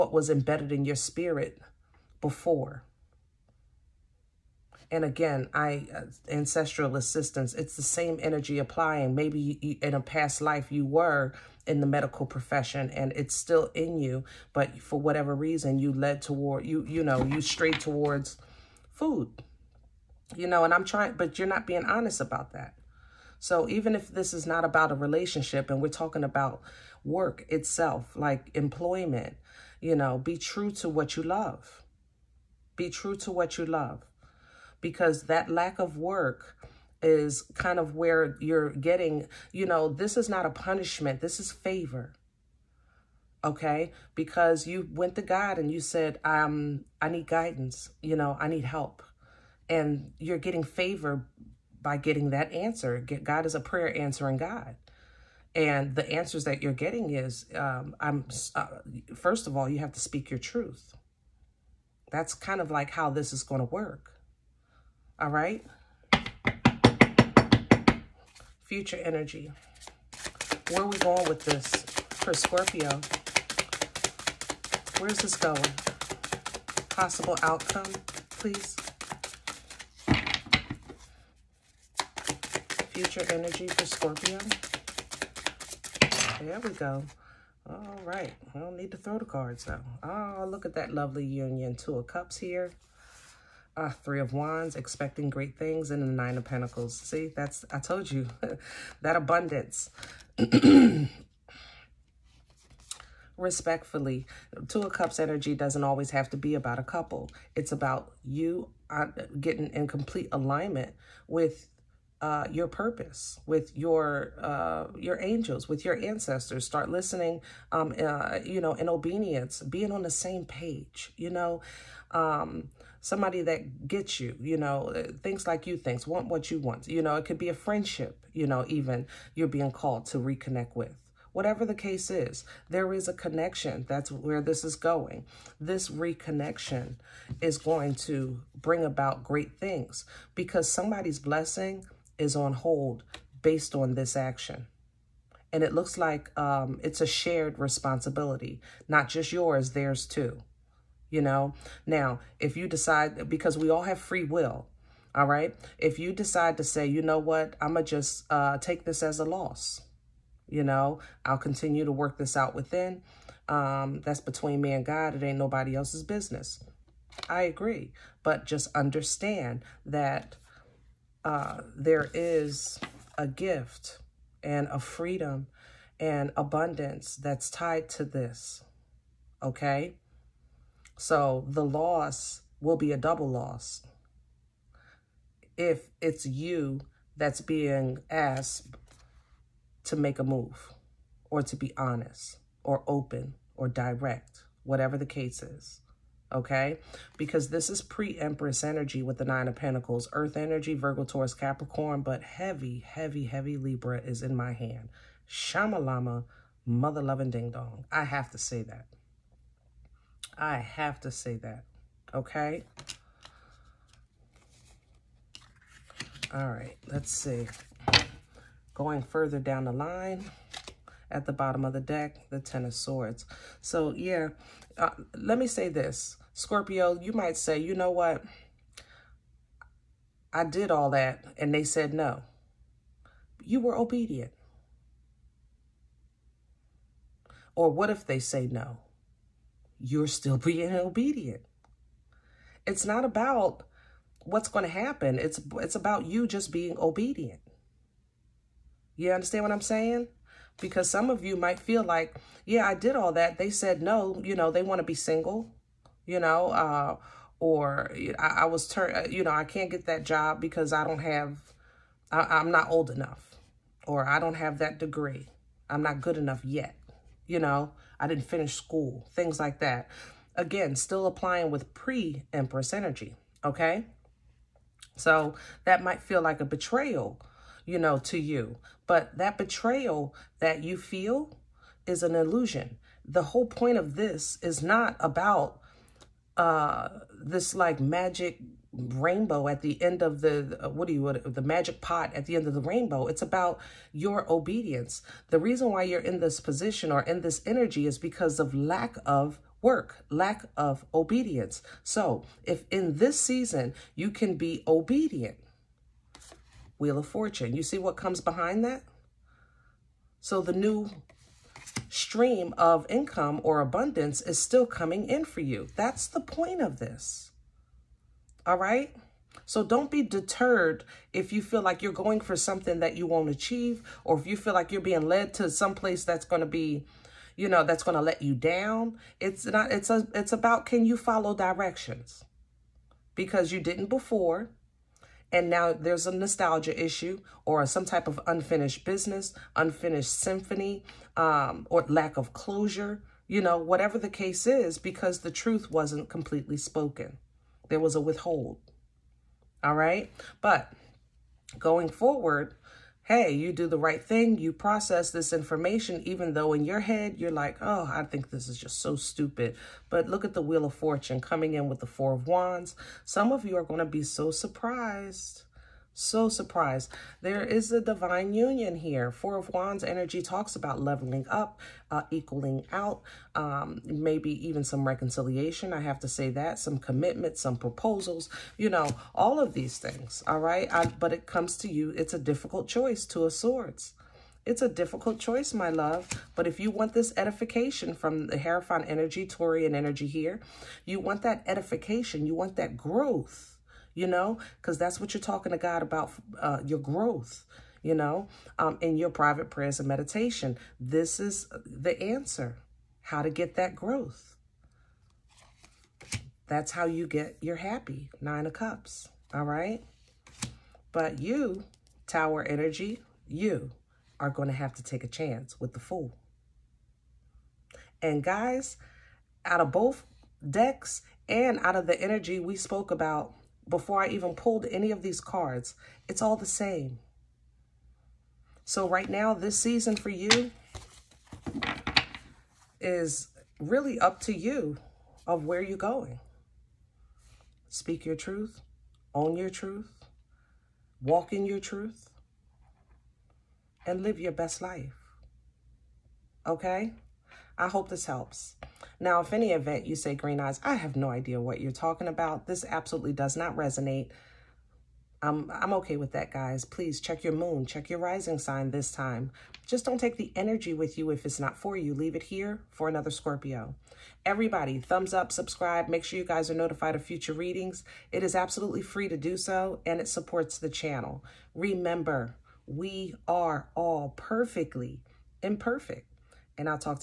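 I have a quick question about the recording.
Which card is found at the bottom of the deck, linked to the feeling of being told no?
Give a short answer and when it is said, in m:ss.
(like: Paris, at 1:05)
Ten of Swords, at 3:42.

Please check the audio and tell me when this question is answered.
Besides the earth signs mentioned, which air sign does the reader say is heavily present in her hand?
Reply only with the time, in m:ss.
3:23.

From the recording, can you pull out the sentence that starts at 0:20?
You know, and I'm trying, but you're not being honest about that.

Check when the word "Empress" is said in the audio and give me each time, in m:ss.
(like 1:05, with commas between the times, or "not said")
3:18, 4:31.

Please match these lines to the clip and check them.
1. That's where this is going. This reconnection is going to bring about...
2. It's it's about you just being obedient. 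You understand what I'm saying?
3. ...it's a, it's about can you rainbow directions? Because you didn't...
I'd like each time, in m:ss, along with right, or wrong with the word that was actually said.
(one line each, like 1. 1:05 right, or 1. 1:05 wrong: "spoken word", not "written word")
1. 2:13 right
2. 4:05 right
3. 5:29 wrong: "follow", not "rainbow".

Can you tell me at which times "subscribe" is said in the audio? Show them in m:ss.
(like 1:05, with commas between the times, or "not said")
7:45.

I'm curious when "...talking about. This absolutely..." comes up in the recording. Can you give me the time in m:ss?
7:31.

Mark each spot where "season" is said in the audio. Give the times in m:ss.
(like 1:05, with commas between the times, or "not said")
5:03, 7:09.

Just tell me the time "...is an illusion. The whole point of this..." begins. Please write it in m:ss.
4:41.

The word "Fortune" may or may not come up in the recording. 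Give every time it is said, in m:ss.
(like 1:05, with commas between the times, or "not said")
5:07, 6:00.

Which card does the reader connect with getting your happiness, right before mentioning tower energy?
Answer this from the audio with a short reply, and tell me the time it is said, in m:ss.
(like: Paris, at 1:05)
Nine of Cups, at 6:48.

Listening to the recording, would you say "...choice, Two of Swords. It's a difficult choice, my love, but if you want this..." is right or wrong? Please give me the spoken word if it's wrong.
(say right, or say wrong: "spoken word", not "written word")
right.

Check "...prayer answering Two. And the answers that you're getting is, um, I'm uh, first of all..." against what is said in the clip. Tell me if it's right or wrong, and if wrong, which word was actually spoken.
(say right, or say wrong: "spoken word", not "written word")
wrong: "God", not "Two".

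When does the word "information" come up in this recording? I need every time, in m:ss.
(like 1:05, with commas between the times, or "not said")
5:55.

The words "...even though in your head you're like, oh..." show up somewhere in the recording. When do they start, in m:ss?
5:56.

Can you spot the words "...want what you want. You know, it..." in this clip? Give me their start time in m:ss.
2:06.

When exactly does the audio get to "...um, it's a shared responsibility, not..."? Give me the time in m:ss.
2:26.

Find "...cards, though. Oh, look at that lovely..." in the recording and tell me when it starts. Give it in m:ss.
1:29.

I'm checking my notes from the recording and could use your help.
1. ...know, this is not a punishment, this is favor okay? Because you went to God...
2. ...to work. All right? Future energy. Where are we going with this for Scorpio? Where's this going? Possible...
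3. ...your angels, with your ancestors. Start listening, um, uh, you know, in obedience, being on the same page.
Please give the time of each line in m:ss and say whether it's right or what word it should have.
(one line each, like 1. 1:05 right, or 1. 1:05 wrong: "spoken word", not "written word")
1. 0:39 right
2. 1:03 right
3. 1:54 right.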